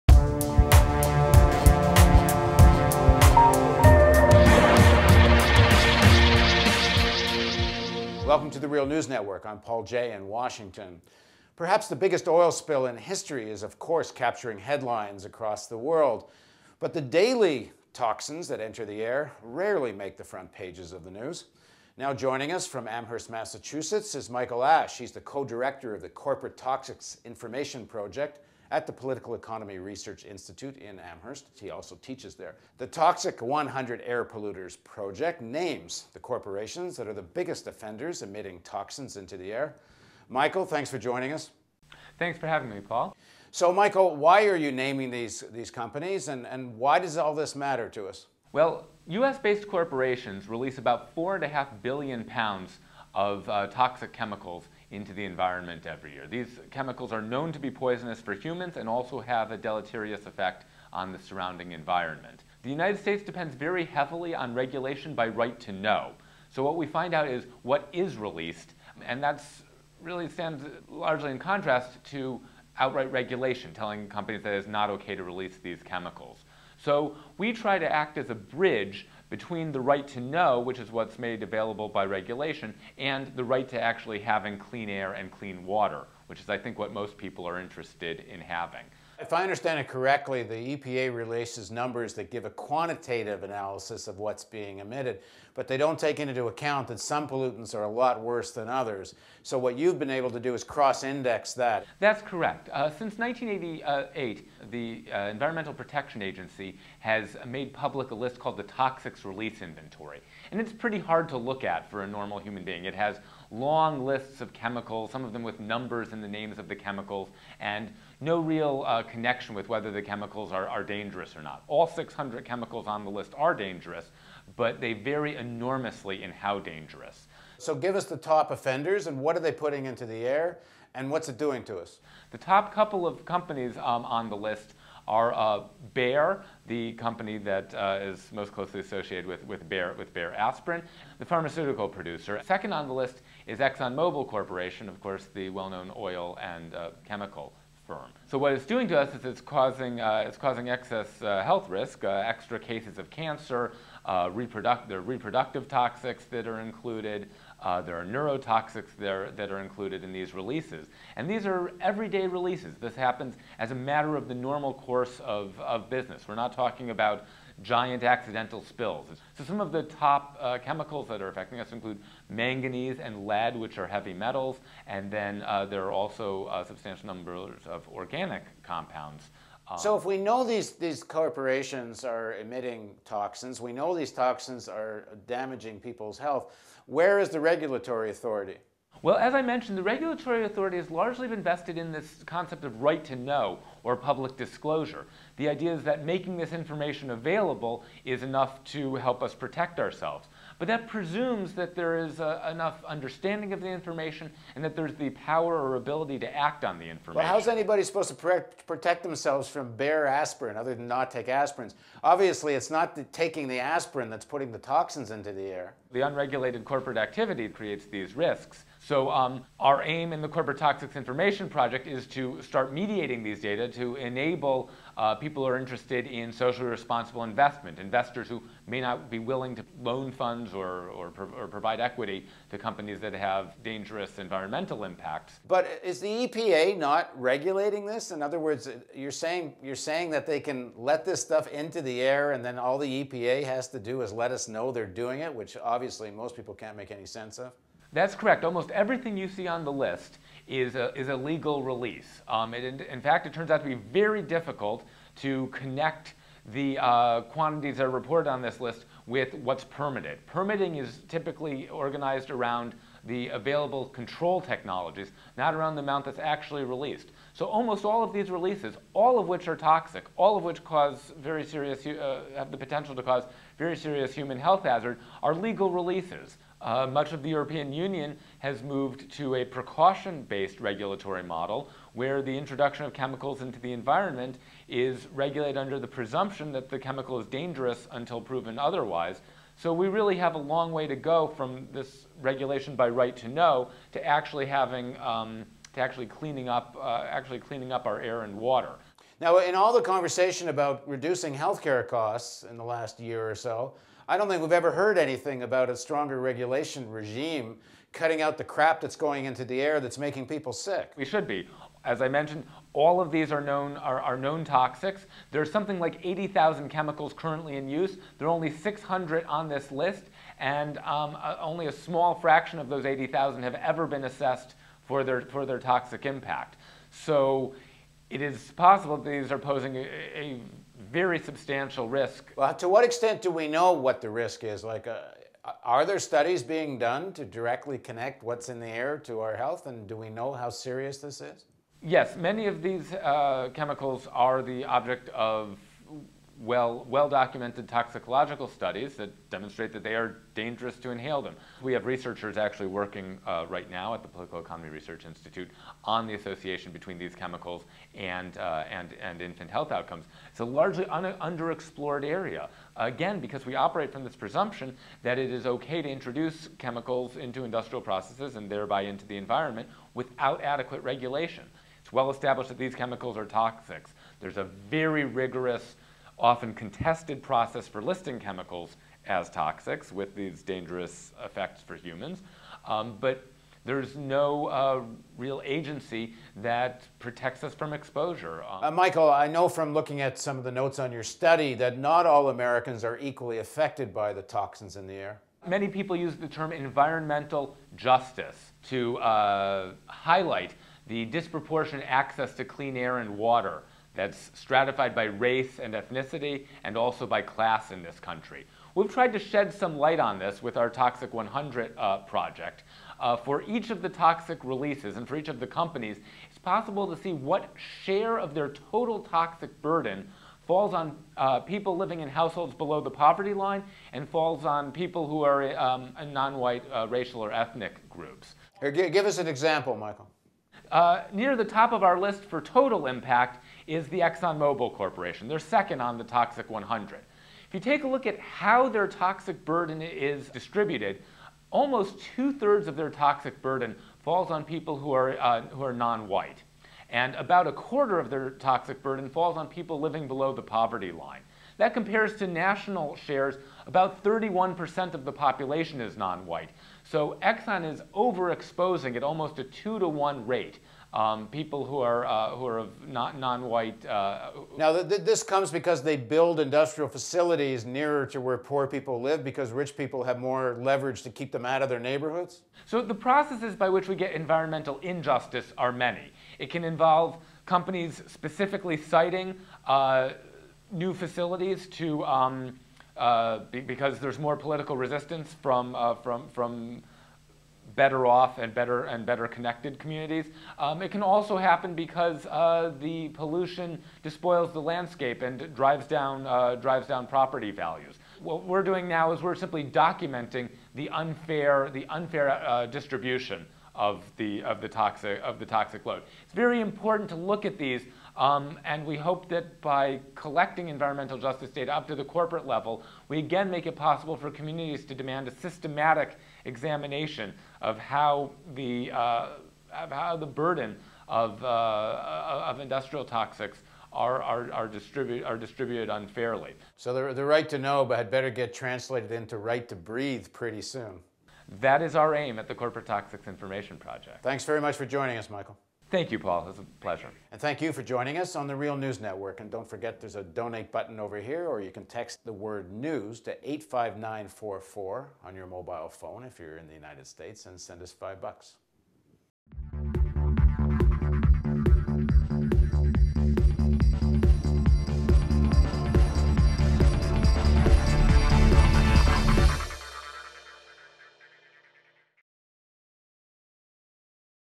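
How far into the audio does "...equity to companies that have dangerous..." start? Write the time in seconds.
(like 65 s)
231 s.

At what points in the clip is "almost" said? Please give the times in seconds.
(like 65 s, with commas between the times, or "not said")
248 s, 267 s, 441 s, 459 s.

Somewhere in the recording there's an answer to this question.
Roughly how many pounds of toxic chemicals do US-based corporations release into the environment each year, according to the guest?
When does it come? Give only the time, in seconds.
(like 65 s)
51 s.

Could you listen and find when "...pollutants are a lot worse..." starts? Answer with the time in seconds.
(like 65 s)
97 s.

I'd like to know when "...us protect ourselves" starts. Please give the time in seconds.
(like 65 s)
199 s.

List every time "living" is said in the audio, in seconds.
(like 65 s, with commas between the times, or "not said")
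421 s, 449 s.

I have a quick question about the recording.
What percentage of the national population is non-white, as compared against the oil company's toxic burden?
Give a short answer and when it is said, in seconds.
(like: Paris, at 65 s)
31%, at 454 s.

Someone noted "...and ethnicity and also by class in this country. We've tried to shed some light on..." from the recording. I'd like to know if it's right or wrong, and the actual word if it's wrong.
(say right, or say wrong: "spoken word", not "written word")
right.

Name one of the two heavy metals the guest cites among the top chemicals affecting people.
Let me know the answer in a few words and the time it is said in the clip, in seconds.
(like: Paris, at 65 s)
manganese, at 172 s.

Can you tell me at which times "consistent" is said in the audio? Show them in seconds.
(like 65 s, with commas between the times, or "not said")
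not said.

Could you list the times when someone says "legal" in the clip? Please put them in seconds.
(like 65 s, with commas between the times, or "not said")
251 s, 275 s.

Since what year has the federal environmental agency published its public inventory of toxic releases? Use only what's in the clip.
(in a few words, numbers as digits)
1988.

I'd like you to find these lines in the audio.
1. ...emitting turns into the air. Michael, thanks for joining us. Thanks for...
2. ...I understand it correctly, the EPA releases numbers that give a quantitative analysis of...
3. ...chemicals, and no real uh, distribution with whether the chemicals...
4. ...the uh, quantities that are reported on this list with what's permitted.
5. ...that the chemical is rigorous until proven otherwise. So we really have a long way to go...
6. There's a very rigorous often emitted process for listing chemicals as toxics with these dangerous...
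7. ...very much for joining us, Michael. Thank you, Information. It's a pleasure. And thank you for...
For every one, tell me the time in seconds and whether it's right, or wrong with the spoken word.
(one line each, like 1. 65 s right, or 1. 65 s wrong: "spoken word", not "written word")
1. 38 s wrong: "toxins", not "turns"
2. 89 s right
3. 116 s wrong: "connection", not "distribution"
4. 256 s right
5. 286 s wrong: "dangerous", not "rigorous"
6. 374 s wrong: "contested", not "emitted"
7. 534 s wrong: "Paul", not "Information".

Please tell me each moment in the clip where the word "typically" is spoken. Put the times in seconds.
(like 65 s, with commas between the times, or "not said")
261 s.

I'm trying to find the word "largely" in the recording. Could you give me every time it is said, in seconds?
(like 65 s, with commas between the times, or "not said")
70 s, 190 s, 360 s.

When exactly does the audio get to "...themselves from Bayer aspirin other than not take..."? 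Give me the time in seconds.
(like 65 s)
209 s.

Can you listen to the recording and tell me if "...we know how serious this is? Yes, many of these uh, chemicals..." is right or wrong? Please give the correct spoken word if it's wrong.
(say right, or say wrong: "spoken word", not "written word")
right.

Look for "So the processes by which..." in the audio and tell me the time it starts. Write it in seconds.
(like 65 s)
472 s.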